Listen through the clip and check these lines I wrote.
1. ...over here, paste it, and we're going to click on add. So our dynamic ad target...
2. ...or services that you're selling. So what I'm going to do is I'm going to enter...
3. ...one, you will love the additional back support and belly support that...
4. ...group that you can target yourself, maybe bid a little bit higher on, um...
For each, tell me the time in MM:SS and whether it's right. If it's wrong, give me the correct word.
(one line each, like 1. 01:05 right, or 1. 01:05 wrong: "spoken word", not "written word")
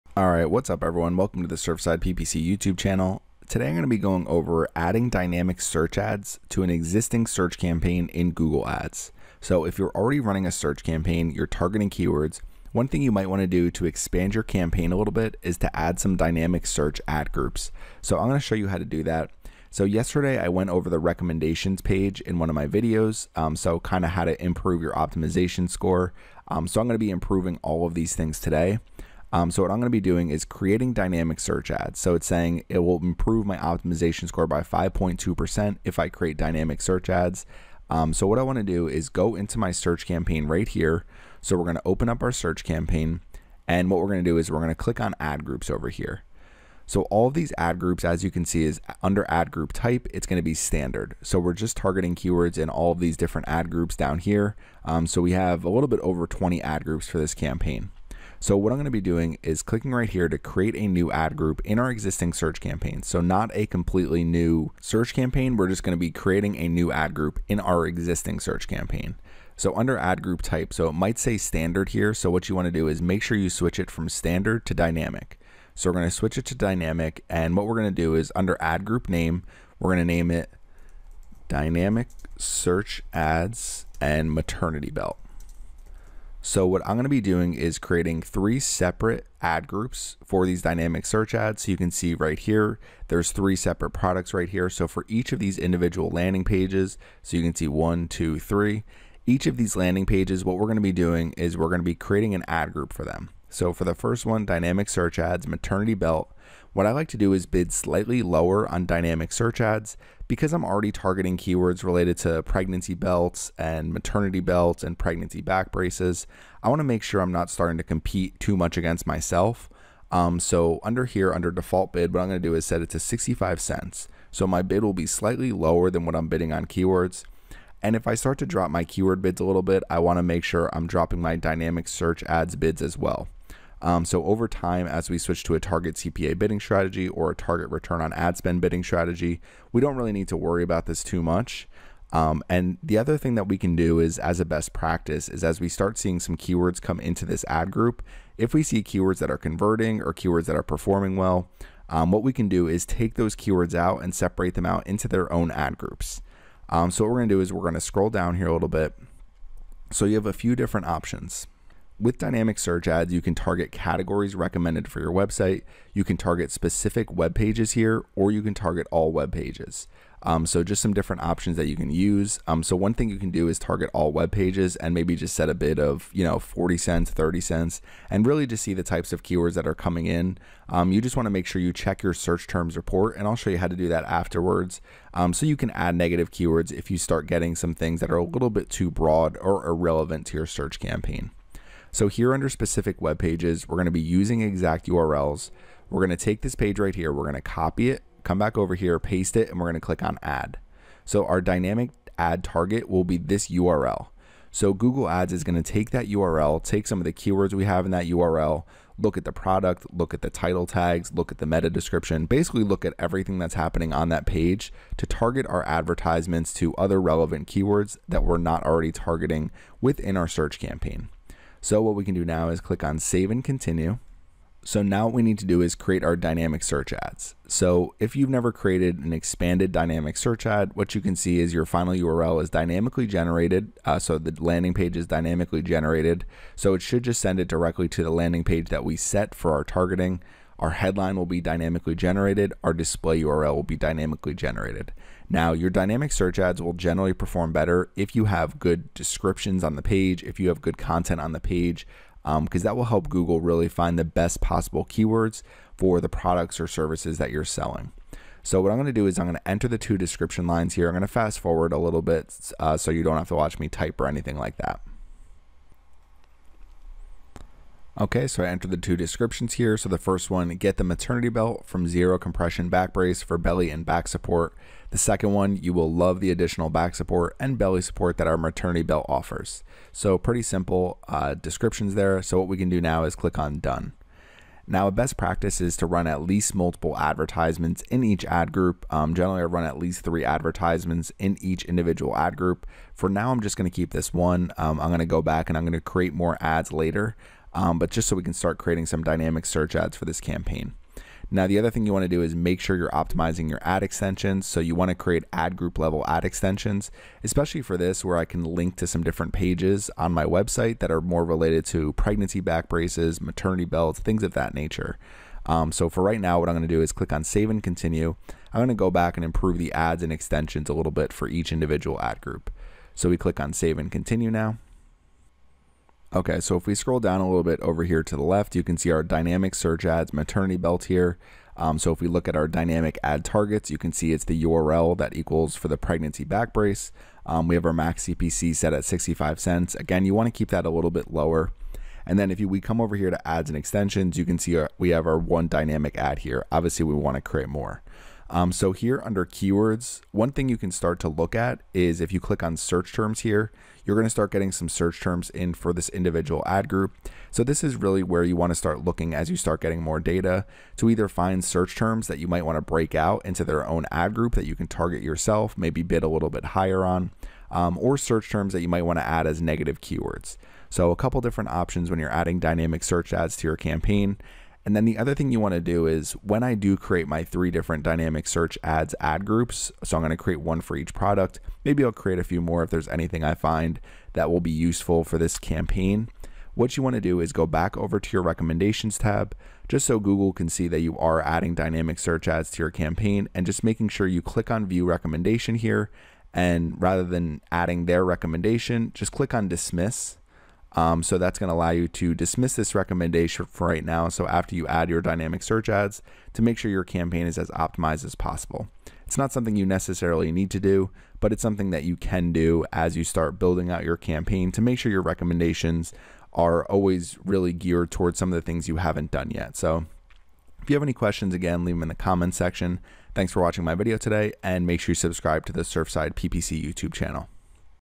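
1. 03:18 right
2. 04:16 right
3. 04:35 right
4. 06:04 right.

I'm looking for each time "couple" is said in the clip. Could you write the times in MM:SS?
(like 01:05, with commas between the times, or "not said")
06:10.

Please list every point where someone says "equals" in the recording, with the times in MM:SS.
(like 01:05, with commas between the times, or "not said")
05:35.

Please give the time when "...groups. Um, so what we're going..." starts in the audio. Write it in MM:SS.
02:35.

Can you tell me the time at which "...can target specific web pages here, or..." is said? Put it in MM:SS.
02:46.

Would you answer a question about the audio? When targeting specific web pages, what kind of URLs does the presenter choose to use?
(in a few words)
exact URLs.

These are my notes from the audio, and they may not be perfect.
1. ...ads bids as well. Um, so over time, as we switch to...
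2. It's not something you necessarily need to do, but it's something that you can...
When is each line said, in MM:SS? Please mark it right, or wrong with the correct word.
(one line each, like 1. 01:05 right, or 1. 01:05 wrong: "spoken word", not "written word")
1. 02:12 right
2. 06:49 right.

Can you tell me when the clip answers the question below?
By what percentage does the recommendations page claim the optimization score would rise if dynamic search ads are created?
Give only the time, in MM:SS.
00:34.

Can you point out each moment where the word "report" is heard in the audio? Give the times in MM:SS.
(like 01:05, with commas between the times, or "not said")
03:02.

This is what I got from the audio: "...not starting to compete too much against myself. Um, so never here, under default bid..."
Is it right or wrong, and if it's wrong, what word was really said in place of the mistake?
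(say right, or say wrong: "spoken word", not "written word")
wrong: "under", not "never".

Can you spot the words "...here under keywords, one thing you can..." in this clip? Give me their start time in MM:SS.
05:48.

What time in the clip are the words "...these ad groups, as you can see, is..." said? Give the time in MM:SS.
00:47.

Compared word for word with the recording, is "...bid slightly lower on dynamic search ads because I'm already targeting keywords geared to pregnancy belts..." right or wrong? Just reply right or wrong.
wrong.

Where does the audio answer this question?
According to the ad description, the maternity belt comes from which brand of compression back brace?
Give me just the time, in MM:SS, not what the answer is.
04:31.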